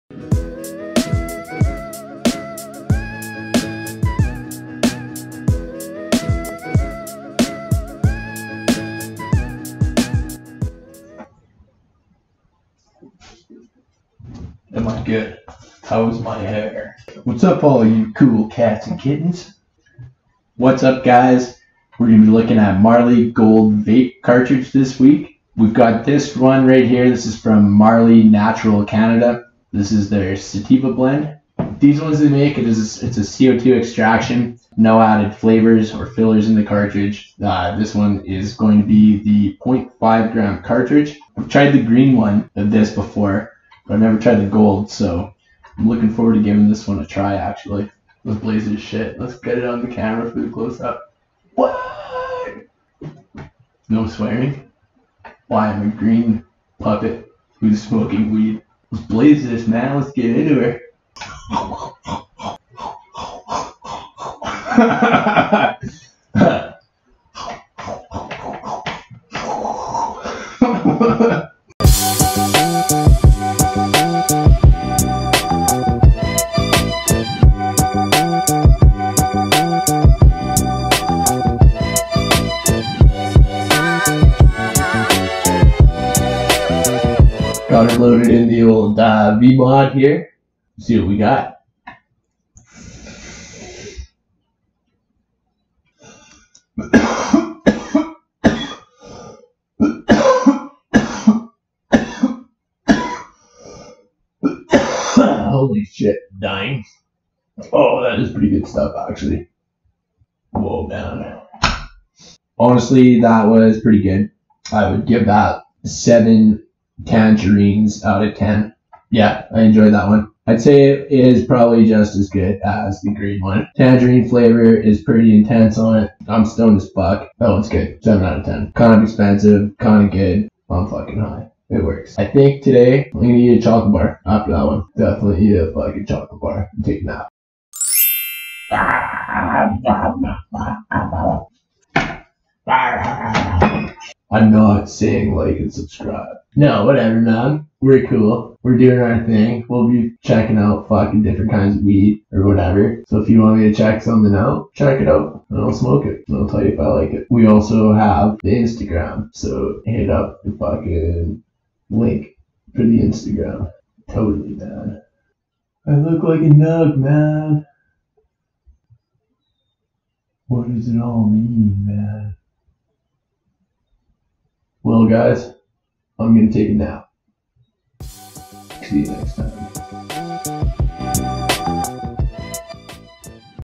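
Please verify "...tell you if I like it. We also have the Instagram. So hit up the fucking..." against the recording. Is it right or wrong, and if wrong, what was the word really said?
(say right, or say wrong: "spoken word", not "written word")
right.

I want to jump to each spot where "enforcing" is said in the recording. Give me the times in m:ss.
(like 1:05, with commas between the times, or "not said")
not said.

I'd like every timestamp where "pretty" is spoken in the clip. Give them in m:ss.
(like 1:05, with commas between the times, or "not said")
1:48, 1:53, 2:05.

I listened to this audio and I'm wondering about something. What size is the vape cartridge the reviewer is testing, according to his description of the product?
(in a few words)
0.5 gram.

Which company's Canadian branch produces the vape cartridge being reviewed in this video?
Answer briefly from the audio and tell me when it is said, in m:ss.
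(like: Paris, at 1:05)
Marley Natural Canada, at 0:27.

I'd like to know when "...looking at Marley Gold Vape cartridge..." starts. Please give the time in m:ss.
0:22.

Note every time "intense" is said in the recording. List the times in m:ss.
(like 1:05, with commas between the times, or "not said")
2:05.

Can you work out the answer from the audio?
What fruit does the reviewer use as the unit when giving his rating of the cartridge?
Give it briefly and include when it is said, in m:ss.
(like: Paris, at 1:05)
Tangerines, at 1:57.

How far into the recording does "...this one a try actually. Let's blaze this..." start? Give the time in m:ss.
0:46.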